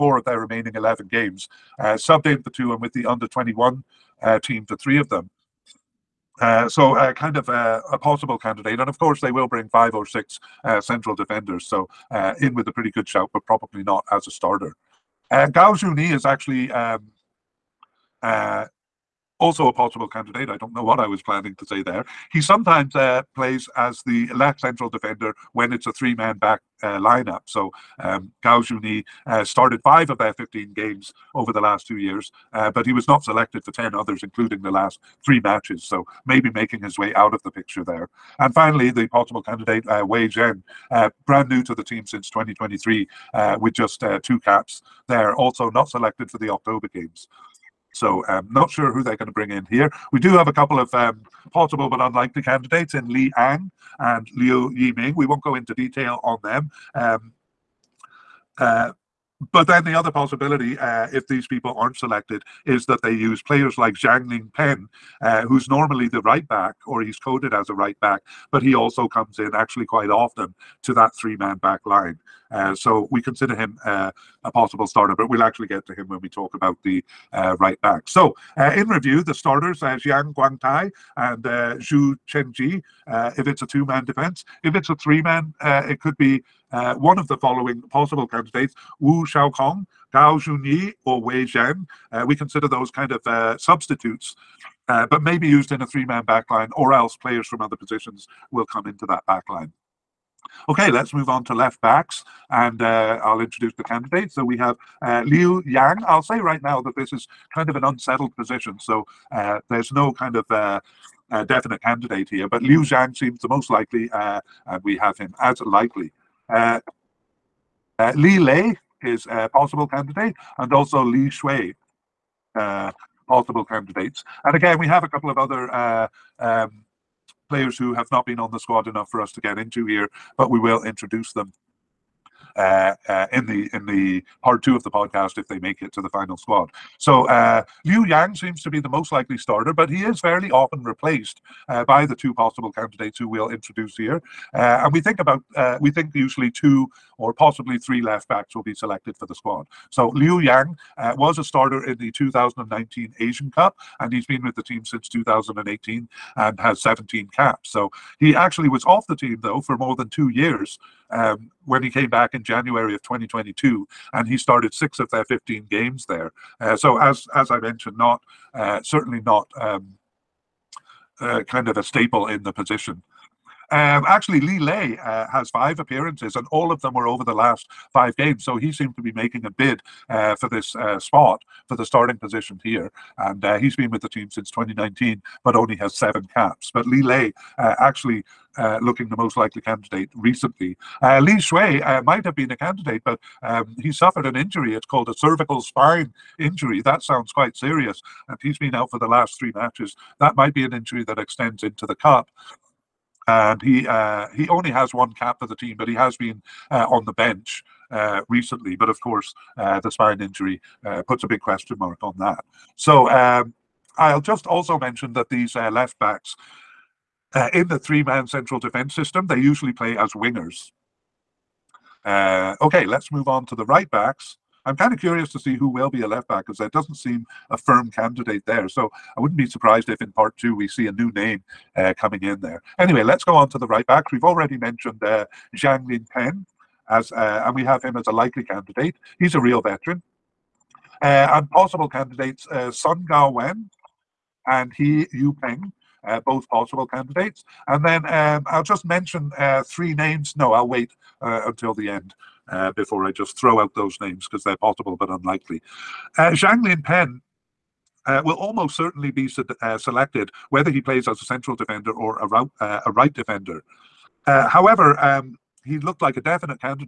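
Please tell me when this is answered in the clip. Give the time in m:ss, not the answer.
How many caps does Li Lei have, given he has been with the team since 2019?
3:05.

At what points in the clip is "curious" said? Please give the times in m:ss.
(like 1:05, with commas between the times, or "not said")
3:44.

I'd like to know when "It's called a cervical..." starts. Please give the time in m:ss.
3:14.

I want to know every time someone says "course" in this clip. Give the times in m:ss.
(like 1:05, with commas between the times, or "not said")
0:08, 3:28.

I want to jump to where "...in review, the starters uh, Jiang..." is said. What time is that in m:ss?
1:18.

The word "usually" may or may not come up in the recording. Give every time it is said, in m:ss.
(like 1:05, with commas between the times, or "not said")
2:26, 3:39.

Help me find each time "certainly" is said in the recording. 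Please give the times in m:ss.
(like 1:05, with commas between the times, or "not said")
2:48, 4:18.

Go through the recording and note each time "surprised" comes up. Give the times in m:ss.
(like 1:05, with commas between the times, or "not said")
3:49.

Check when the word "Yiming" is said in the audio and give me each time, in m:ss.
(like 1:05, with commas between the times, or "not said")
0:54.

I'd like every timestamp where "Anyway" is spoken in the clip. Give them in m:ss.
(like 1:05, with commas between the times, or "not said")
3:52.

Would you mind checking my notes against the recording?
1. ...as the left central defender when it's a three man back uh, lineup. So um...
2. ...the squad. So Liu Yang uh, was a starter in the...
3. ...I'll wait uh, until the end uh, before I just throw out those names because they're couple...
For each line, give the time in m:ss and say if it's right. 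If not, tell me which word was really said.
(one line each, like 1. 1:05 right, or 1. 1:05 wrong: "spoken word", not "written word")
1. 0:23 right
2. 2:29 right
3. 4:10 wrong: "possible", not "couple".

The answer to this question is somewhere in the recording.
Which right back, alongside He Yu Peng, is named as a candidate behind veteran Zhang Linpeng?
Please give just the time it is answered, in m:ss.
4:02.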